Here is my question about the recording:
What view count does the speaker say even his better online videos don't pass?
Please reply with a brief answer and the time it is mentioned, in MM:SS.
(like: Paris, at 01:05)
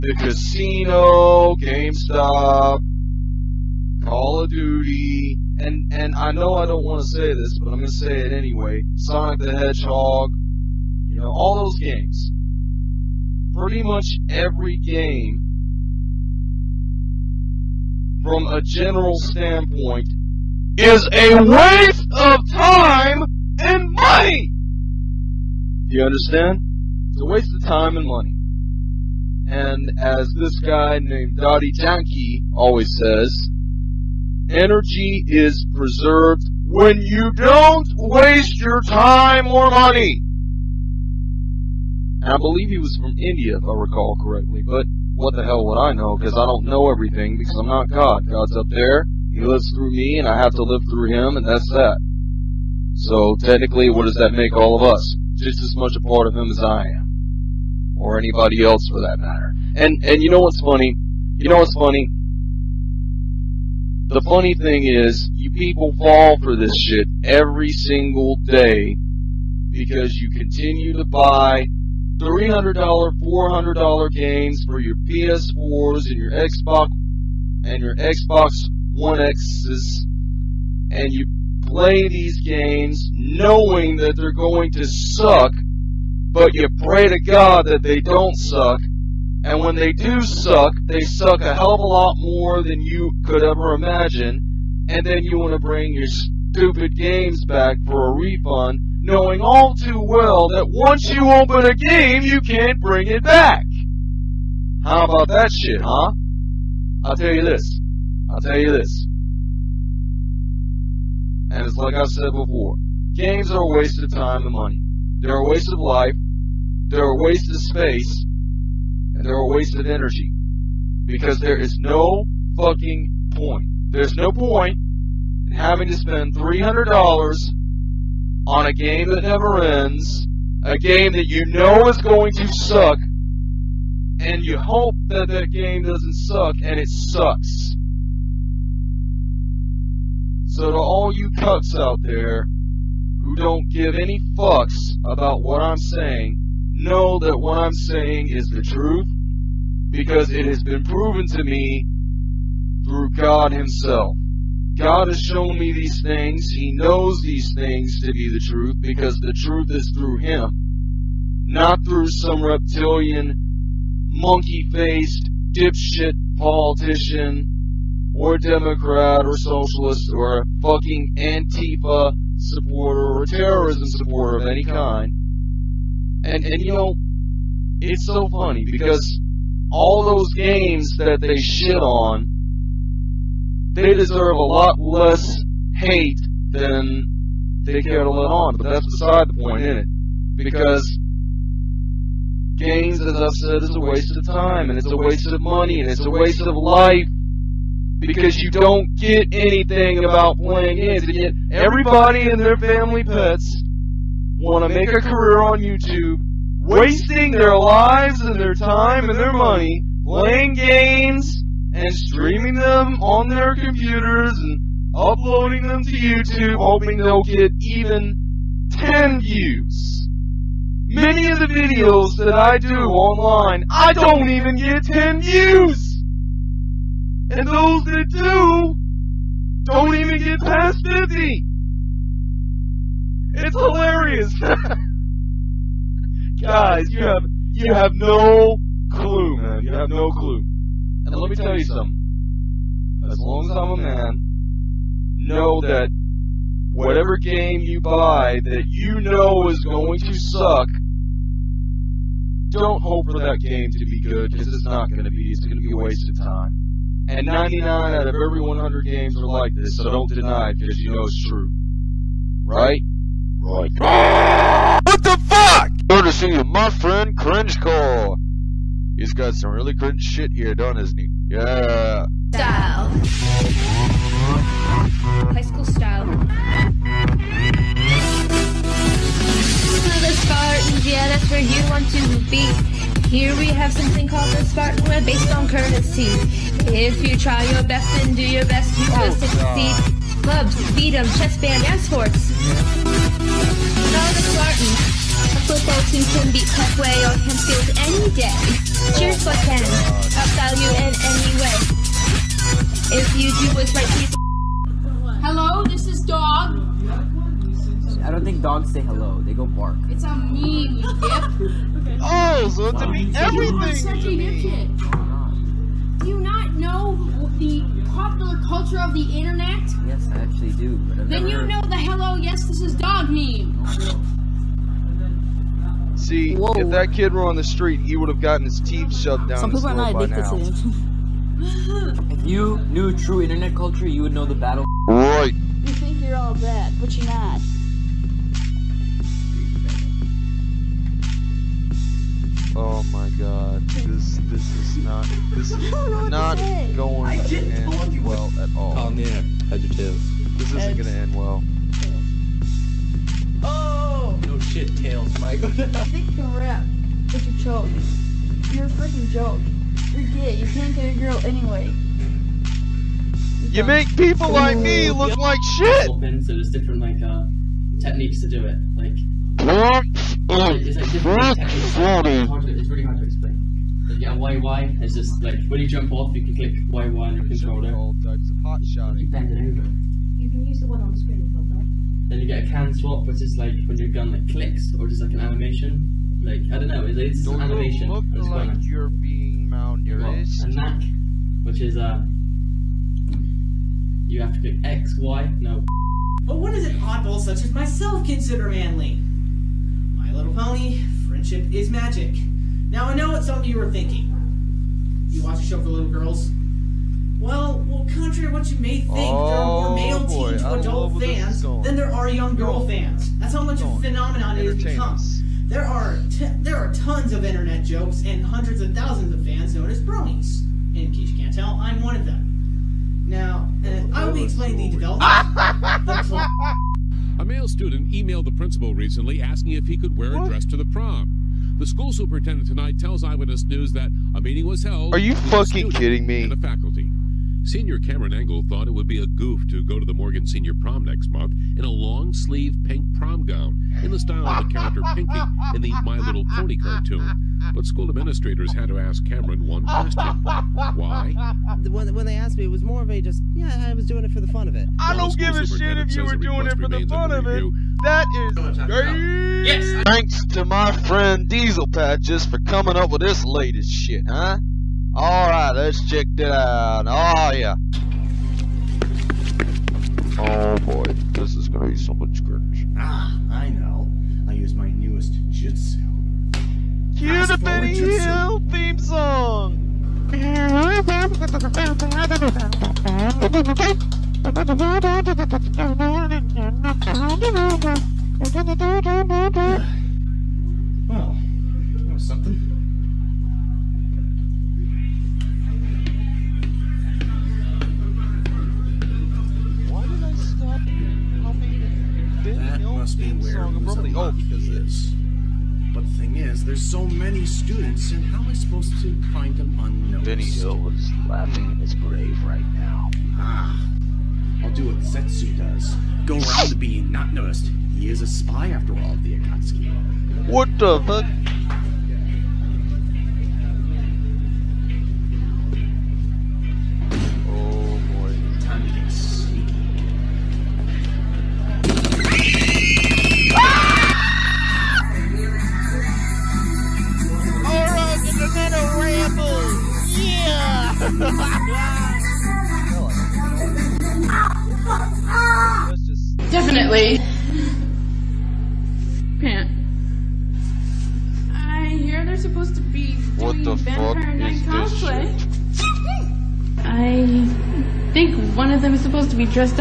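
50, at 03:50.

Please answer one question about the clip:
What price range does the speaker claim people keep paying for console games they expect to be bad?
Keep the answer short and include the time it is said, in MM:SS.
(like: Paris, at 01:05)
$300, $400, at 01:12.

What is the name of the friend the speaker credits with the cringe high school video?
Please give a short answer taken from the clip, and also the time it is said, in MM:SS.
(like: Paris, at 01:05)
Cringe call, at 04:27.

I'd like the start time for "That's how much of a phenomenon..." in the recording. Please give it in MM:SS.
06:53.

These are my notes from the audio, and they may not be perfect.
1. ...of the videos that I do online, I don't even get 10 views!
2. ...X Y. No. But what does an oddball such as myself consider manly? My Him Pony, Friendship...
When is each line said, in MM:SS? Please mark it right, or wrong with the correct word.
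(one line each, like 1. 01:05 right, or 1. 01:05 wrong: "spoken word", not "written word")
1. 03:41 right
2. 06:34 wrong: "Little", not "Him".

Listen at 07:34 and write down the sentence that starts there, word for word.
I don't give a shit if you were doing it for the fun of review, it.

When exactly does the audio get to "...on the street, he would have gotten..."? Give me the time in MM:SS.
05:27.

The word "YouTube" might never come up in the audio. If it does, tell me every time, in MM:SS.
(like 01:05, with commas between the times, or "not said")
03:25, 03:35.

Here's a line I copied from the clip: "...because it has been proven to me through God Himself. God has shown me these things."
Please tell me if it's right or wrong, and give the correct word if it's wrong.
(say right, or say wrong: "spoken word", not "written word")
right.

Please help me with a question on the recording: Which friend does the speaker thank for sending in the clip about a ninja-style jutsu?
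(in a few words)
Diesel Patches.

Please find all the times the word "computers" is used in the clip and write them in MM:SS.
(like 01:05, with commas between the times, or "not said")
03:33.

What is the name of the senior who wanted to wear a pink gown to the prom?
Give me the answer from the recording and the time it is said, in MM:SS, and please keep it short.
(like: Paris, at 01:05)
Cameron Engel, at 07:17.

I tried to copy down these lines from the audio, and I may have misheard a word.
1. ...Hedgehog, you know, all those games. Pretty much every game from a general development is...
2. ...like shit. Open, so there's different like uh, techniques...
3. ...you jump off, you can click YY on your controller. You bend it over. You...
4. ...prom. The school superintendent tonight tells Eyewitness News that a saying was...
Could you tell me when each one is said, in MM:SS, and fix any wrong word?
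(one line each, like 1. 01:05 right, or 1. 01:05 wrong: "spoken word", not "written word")
1. 00:09 wrong: "standpoint", not "development"
2. 06:05 right
3. 06:15 right
4. 07:10 wrong: "meeting", not "saying".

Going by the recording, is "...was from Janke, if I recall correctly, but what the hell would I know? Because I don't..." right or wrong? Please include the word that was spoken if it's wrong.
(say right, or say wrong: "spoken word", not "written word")
wrong: "India", not "Janke".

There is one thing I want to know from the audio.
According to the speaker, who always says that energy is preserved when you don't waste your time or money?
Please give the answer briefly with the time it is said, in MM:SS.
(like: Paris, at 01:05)
Dottie Janke, at 00:31.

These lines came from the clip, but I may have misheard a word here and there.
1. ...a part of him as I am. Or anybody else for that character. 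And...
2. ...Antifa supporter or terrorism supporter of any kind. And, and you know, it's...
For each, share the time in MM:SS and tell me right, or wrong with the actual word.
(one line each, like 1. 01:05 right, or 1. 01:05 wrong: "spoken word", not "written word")
1. 00:55 wrong: "matter", not "character"
2. 02:51 right.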